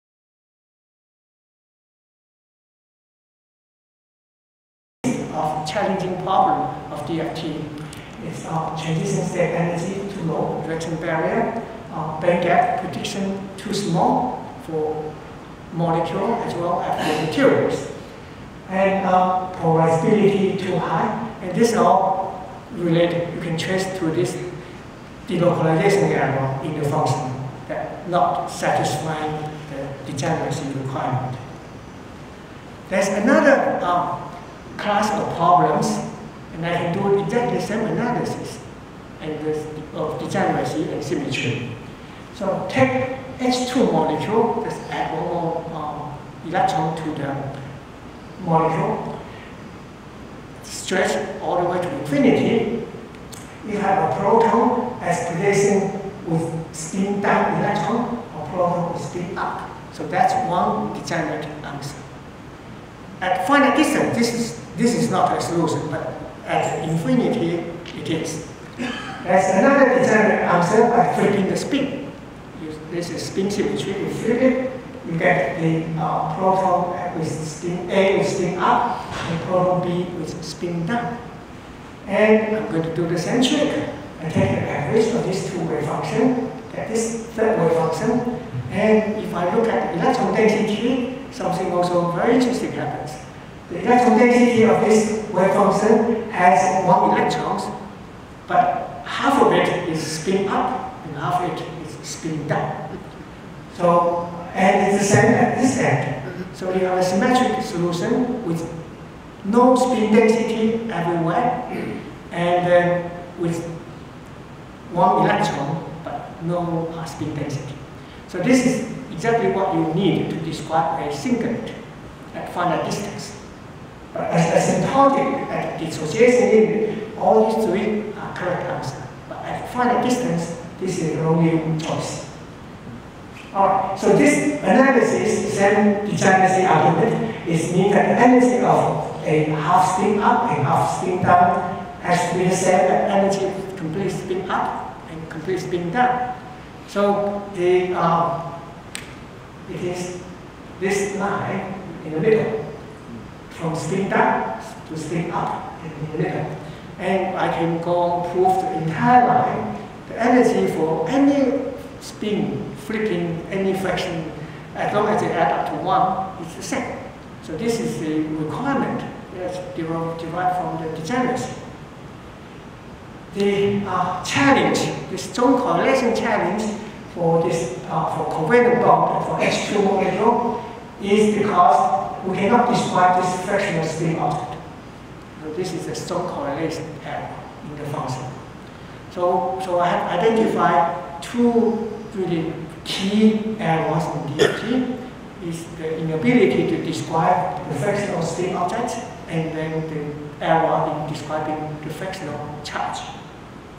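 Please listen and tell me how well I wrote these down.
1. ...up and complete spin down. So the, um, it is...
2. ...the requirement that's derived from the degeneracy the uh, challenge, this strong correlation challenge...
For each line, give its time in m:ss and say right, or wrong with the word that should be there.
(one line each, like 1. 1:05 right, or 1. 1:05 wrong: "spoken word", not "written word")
1. 2:24 right
2. 2:48 right.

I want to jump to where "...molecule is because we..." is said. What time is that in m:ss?
2:59.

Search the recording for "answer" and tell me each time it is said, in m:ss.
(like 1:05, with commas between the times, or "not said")
1:01, 1:10, 2:08.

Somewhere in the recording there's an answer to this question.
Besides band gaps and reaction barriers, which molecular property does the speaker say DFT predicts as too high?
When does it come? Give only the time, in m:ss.
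0:19.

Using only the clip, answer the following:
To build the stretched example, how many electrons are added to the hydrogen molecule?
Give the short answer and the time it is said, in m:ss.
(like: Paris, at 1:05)
1, at 0:45.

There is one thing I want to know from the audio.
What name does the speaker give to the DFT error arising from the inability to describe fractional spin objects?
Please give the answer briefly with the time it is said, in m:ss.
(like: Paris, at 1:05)
Strong correlation error, at 3:05.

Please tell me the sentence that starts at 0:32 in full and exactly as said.
There's another uh, class of problems, and I can do exactly the same analysis and of degeneracy and symmetry.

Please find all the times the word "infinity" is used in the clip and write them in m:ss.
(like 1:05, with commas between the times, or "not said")
0:51, 1:06.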